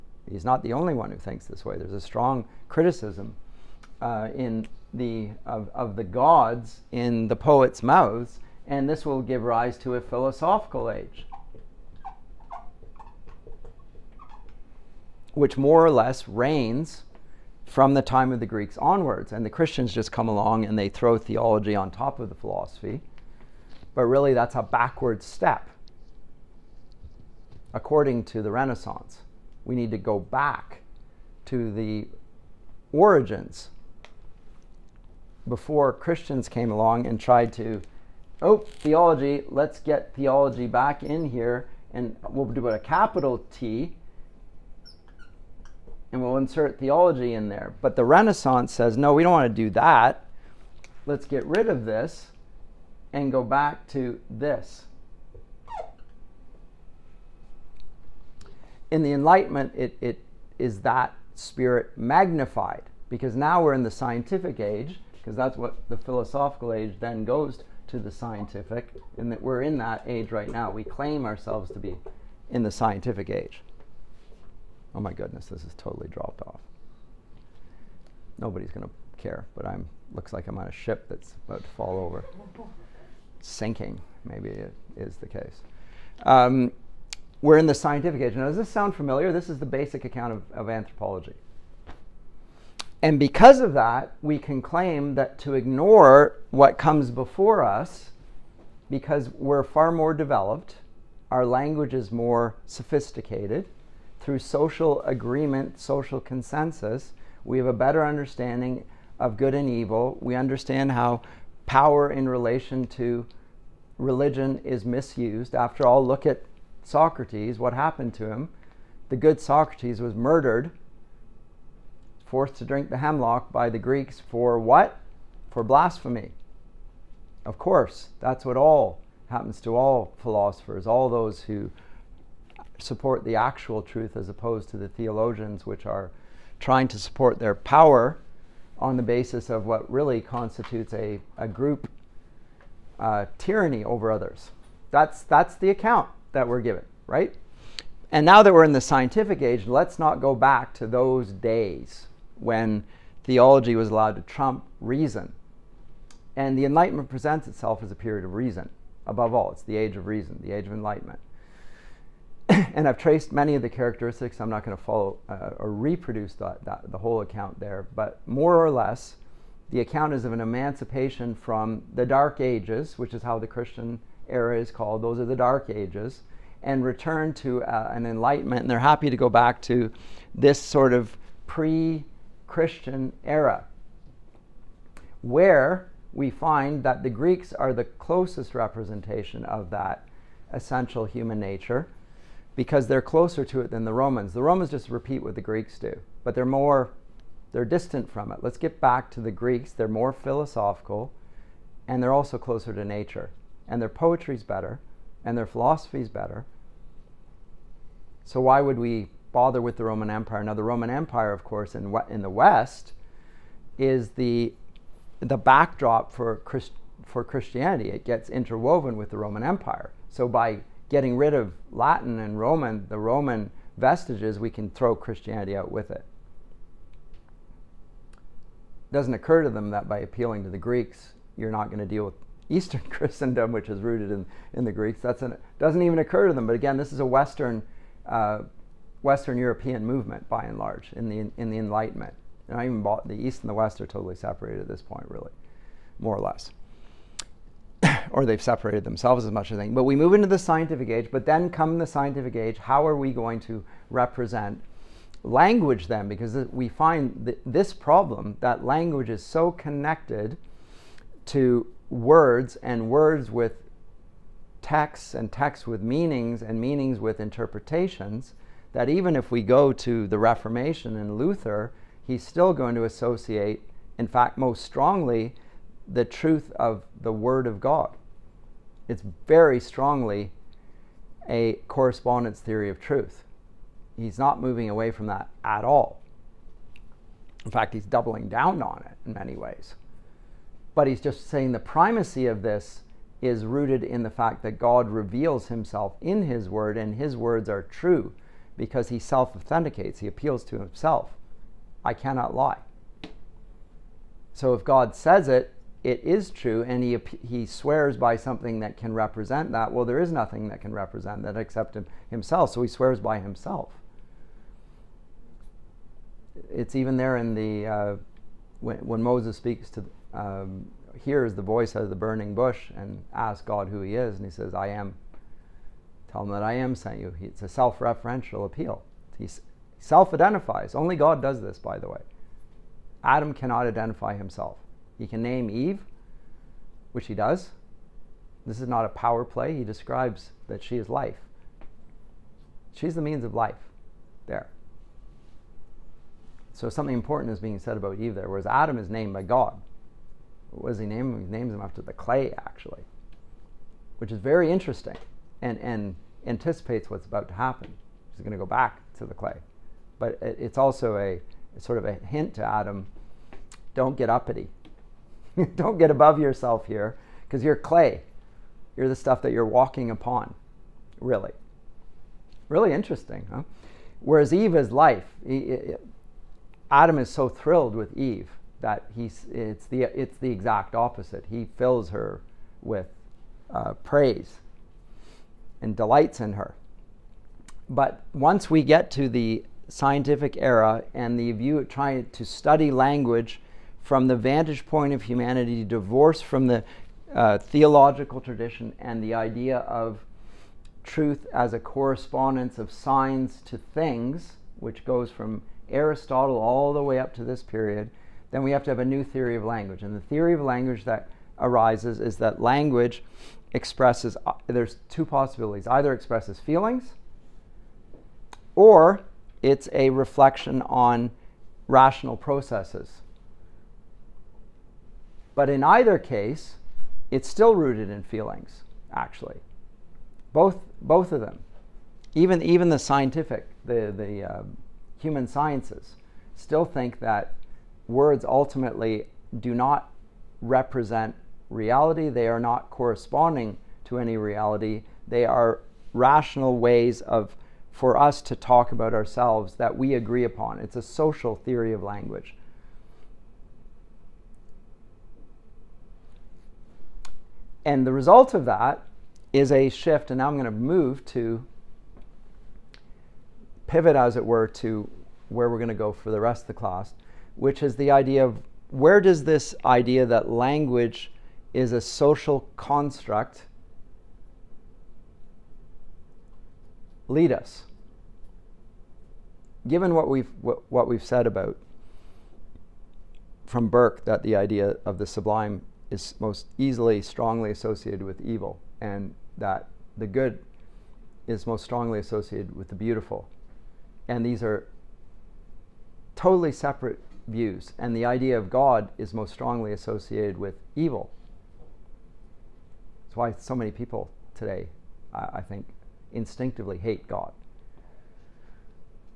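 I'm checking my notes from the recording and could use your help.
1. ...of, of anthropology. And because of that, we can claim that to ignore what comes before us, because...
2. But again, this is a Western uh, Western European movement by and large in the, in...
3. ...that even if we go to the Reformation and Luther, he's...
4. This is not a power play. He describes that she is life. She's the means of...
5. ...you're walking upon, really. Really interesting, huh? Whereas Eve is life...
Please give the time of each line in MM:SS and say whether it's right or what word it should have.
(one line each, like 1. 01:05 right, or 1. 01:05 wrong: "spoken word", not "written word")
1. 01:30 right
2. 03:56 right
3. 04:28 right
4. 05:38 right
5. 06:09 right.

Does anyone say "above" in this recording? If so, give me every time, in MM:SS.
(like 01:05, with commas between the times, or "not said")
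02:39, 06:05.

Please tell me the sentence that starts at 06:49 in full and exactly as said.
And the theory of language that arises is that language expresses, uh, there's two possibilities.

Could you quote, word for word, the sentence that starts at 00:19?
And the Christians just come along and they throw theology on top of the philosophy.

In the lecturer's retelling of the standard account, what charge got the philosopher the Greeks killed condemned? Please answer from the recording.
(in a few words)
blasphemy.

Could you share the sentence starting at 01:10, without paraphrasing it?
We claim ourselves to be in the scientific age.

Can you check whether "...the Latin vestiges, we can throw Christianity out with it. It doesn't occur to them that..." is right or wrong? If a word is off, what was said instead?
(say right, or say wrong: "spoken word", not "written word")
wrong: "Roman", not "Latin".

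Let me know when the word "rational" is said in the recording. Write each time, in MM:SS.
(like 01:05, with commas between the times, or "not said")
07:01, 07:25.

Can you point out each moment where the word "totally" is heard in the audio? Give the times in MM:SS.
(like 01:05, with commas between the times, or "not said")
01:15, 04:03, 08:16.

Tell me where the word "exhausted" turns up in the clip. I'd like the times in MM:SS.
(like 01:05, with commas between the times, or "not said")
not said.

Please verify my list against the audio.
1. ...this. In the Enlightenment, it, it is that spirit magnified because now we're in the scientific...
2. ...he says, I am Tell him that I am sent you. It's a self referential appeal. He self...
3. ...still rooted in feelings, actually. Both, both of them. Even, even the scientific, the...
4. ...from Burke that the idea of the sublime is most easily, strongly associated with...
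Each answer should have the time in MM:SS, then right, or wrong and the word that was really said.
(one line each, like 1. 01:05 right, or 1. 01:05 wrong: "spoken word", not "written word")
1. 00:54 right
2. 05:24 right
3. 07:07 right
4. 08:03 right.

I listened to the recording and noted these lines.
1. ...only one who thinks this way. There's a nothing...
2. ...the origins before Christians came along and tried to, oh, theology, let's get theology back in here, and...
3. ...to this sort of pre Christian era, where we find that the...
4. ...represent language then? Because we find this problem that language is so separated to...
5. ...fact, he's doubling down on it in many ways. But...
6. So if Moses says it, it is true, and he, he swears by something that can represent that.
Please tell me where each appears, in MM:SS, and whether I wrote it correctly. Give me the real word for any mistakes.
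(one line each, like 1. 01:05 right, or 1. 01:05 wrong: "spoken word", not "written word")
1. 00:00 wrong: "strong", not "nothing"
2. 00:31 right
3. 02:59 right
4. 04:13 wrong: "connected", not "separated"
5. 04:47 right
6. 05:04 wrong: "God", not "Moses".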